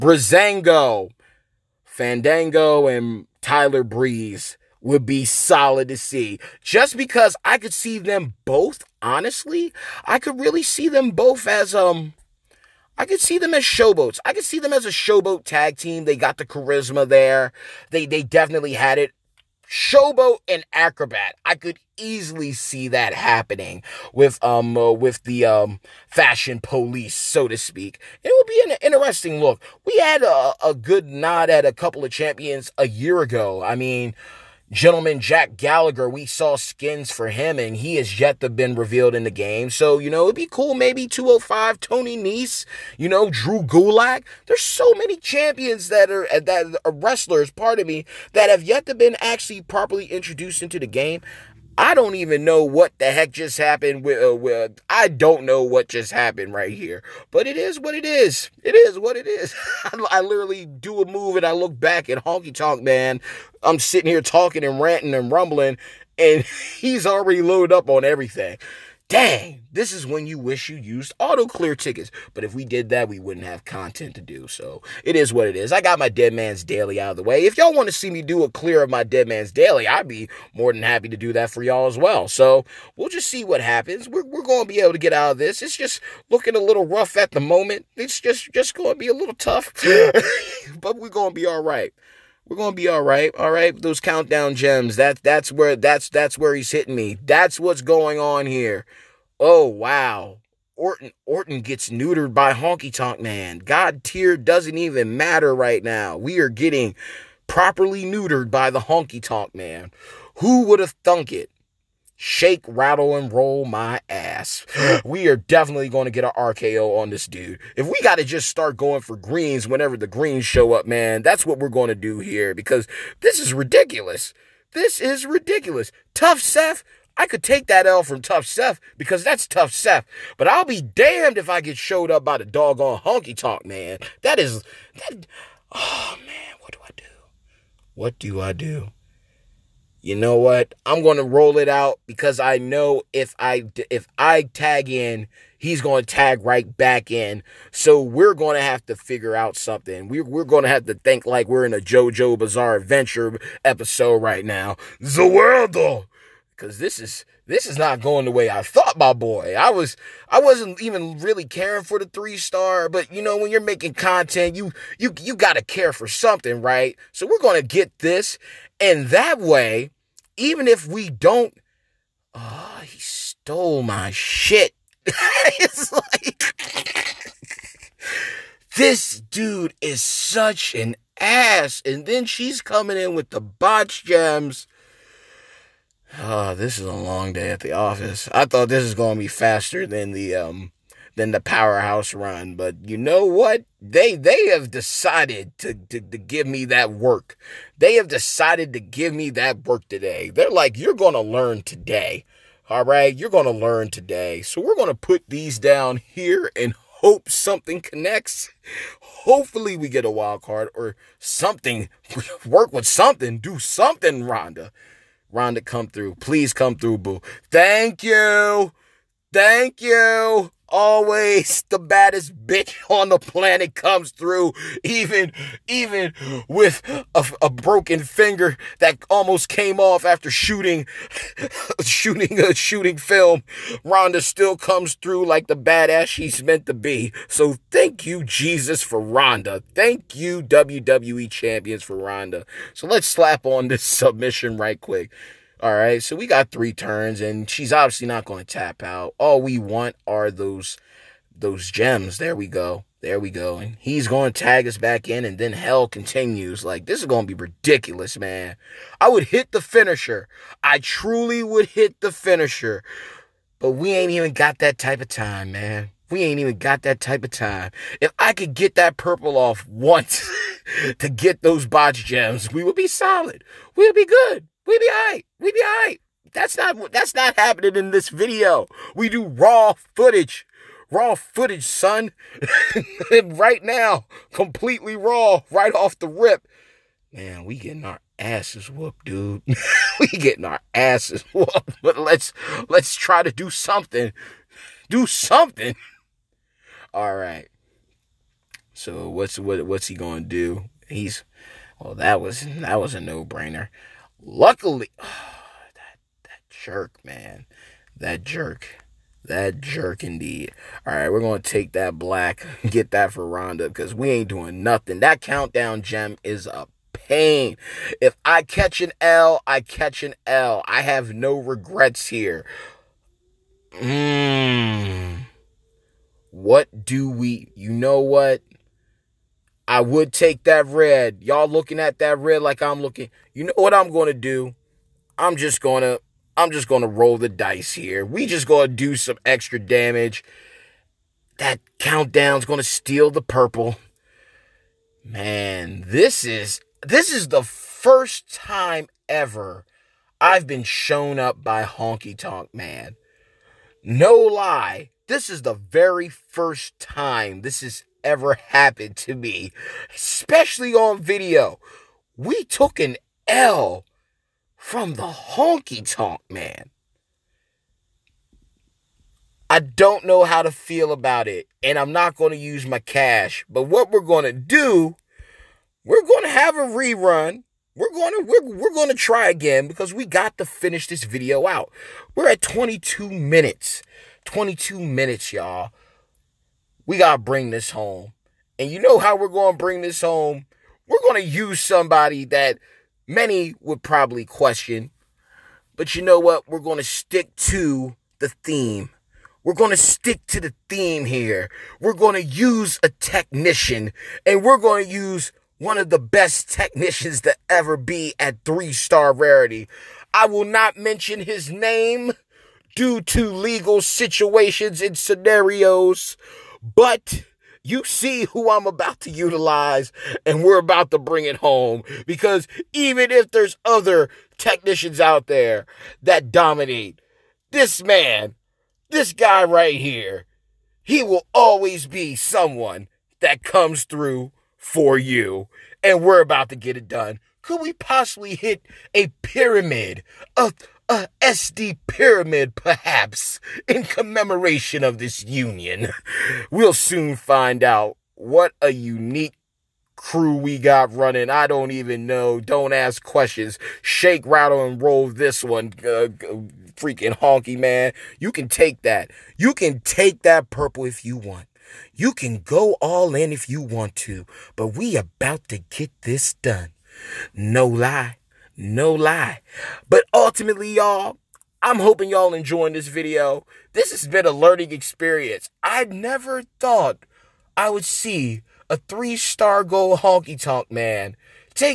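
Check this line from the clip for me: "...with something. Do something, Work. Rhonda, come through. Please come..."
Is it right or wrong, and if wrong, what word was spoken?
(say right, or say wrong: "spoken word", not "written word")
wrong: "Rhonda", not "Work".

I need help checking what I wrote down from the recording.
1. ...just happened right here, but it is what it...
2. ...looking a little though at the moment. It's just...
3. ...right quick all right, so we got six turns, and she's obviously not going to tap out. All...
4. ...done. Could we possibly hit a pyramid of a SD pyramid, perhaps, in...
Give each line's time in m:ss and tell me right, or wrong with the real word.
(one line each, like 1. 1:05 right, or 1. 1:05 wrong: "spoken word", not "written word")
1. 0:55 right
2. 1:26 wrong: "rough", not "though"
3. 4:04 wrong: "three", not "six"
4. 7:16 right.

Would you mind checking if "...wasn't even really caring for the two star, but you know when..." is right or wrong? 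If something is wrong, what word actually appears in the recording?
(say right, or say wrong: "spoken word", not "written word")
wrong: "three", not "two".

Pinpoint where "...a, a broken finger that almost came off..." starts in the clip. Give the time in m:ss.
3:47.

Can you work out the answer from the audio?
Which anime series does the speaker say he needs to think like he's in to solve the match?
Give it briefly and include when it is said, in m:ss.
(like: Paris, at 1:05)
JoJo's Bizarre Adventure, at 2:31.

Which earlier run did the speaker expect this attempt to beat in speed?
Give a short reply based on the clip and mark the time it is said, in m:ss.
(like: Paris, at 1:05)
the powerhouse run, at 3:11.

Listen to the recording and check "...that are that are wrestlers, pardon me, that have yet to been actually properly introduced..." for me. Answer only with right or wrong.
right.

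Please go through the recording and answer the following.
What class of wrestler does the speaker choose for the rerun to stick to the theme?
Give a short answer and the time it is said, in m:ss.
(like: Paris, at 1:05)
technician, at 6:42.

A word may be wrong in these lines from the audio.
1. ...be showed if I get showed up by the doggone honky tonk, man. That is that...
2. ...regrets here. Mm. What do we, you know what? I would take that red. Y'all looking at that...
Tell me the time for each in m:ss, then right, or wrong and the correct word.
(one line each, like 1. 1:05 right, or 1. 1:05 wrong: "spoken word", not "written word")
1. 2:10 wrong: "damned", not "showed"
2. 5:21 right.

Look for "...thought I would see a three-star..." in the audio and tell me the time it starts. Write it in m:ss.
7:56.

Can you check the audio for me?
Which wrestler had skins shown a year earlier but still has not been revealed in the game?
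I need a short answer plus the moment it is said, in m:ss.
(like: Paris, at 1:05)
Jack Gallagher, at 0:34.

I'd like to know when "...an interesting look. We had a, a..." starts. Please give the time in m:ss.
0:28.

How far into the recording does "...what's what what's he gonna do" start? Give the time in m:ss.
4:59.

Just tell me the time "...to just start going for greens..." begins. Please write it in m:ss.
1:58.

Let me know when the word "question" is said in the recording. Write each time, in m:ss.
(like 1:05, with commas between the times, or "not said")
6:34, 7:33.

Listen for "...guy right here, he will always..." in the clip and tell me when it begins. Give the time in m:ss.
7:09.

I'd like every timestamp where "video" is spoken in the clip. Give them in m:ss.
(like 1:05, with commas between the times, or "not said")
4:38, 6:01, 6:21, 7:52.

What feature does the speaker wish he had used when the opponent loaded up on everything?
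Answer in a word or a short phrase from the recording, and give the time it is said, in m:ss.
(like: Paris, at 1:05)
auto clear tickets, at 1:11.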